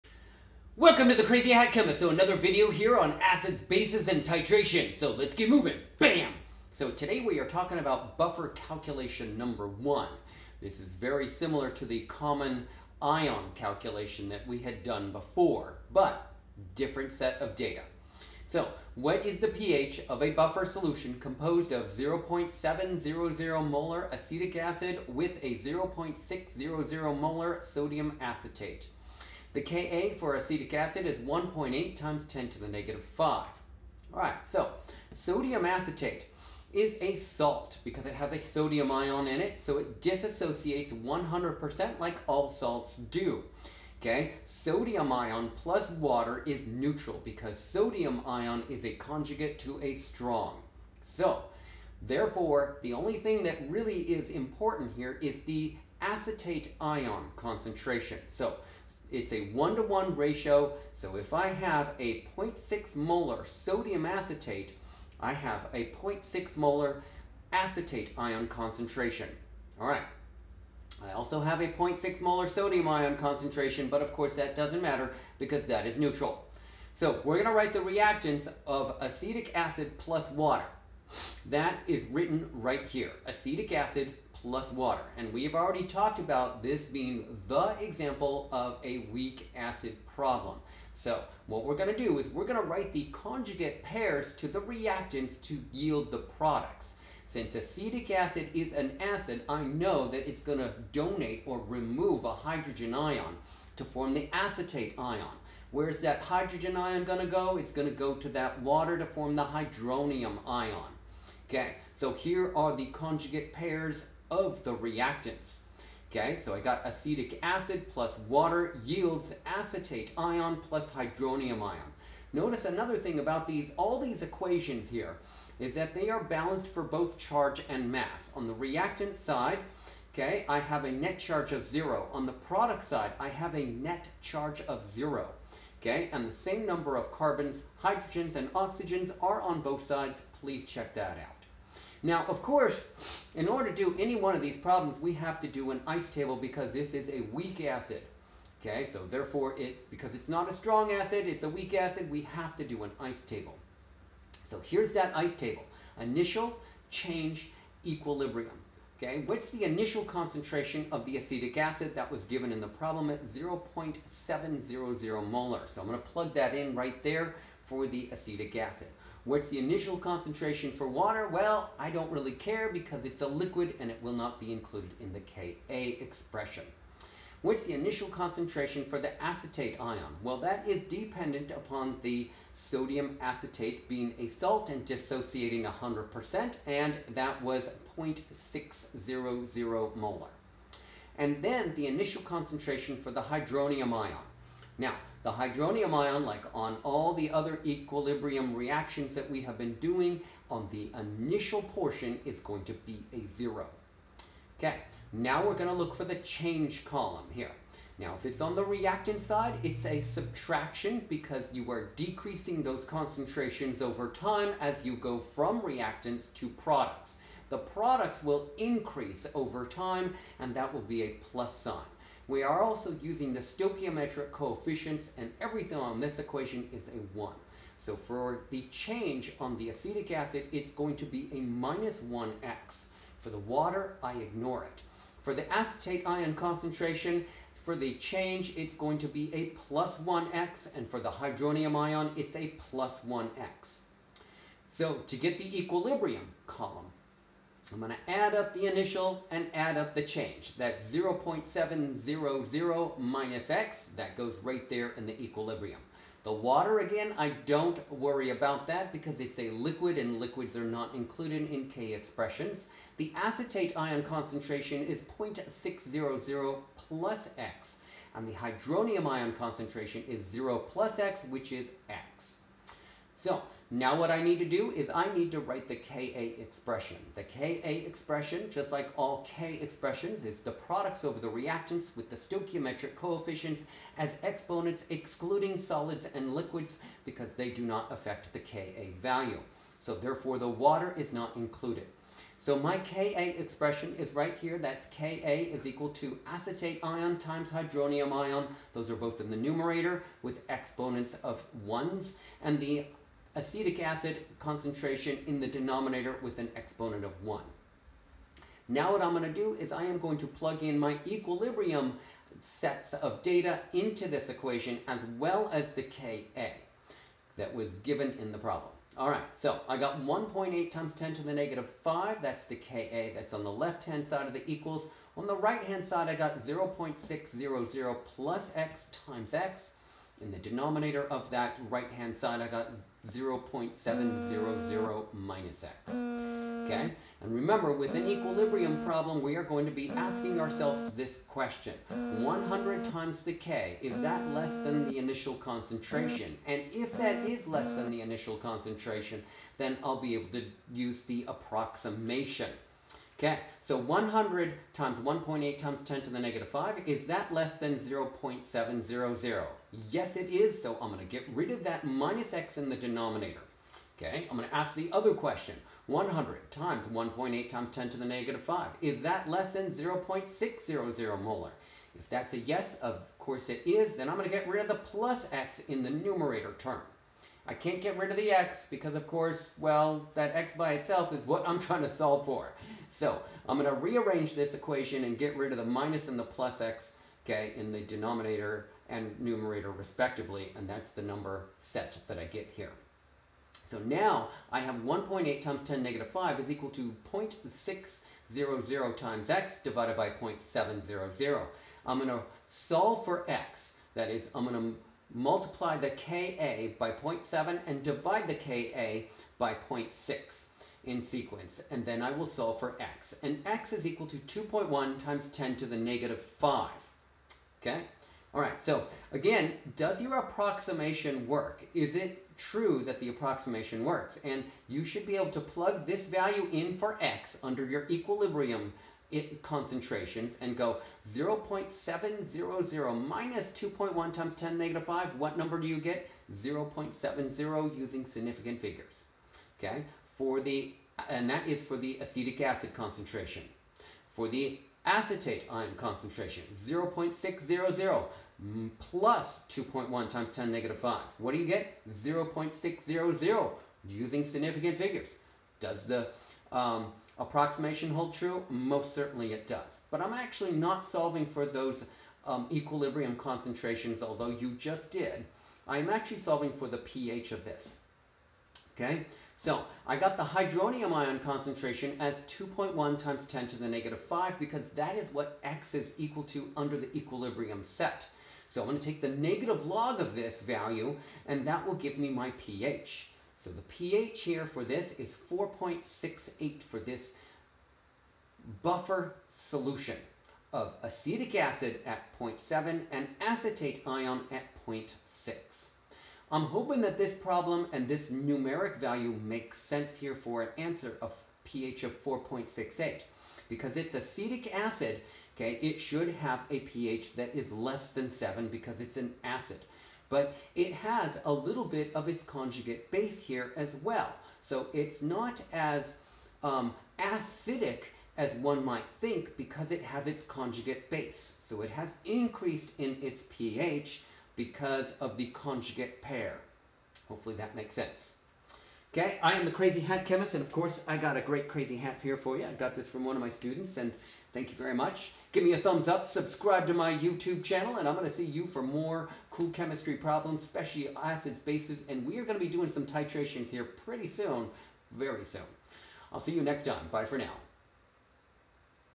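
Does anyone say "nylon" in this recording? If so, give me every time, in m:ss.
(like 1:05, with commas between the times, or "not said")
not said.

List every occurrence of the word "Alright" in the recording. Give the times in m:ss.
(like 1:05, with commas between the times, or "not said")
0:34, 5:18.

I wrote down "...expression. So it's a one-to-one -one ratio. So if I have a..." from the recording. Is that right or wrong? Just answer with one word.
wrong.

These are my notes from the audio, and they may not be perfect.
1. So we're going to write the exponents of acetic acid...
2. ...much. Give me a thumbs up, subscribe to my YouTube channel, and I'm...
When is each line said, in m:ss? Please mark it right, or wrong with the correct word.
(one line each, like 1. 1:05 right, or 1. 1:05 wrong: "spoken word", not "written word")
1. 1:16 wrong: "reactants", not "exponents"
2. 8:54 right.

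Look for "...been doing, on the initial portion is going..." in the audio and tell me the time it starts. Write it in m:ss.
3:19.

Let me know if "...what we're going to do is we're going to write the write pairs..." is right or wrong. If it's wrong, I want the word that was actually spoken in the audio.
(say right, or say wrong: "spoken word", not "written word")
wrong: "conjugate", not "write".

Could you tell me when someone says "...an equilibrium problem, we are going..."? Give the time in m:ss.
5:37.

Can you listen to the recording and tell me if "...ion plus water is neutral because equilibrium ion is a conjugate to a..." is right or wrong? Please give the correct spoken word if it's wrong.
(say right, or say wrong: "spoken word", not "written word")
wrong: "sodium", not "equilibrium".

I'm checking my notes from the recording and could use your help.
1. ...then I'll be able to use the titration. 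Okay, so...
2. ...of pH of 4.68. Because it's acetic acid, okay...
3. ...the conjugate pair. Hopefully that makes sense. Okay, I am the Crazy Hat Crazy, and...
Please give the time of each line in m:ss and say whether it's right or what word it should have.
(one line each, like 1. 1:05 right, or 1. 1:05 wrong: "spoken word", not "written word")
1. 5:49 wrong: "approximation", not "titration"
2. 8:21 right
3. 8:45 wrong: "Chemist", not "Crazy".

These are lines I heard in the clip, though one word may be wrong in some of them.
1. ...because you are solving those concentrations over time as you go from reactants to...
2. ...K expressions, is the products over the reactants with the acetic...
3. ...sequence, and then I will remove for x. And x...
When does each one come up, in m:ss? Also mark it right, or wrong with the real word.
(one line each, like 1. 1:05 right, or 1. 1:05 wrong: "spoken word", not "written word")
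1. 3:31 wrong: "decreasing", not "solving"
2. 4:39 wrong: "stoichiometric", not "acetic"
3. 6:51 wrong: "solve", not "remove".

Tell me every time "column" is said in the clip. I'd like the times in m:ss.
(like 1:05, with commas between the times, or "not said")
3:26, 4:06.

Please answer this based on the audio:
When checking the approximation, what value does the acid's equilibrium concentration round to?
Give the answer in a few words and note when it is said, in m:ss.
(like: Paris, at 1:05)
0.70, at 7:16.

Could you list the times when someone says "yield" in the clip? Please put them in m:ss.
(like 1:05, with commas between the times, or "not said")
1:35, 1:58.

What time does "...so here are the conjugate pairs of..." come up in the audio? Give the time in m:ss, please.
1:51.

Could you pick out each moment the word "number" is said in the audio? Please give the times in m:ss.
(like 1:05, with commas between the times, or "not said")
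0:09, 2:16, 6:31, 7:15.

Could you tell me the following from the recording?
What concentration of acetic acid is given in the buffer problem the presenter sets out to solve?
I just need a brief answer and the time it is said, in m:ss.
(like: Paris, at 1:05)
0.700 molar, at 0:21.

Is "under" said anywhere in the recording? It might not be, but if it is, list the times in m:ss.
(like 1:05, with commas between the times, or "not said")
7:07, 7:56.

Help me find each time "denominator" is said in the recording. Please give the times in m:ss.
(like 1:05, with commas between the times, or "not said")
5:05, 5:30, 6:02, 6:27.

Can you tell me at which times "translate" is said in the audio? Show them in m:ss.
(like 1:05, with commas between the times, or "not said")
not said.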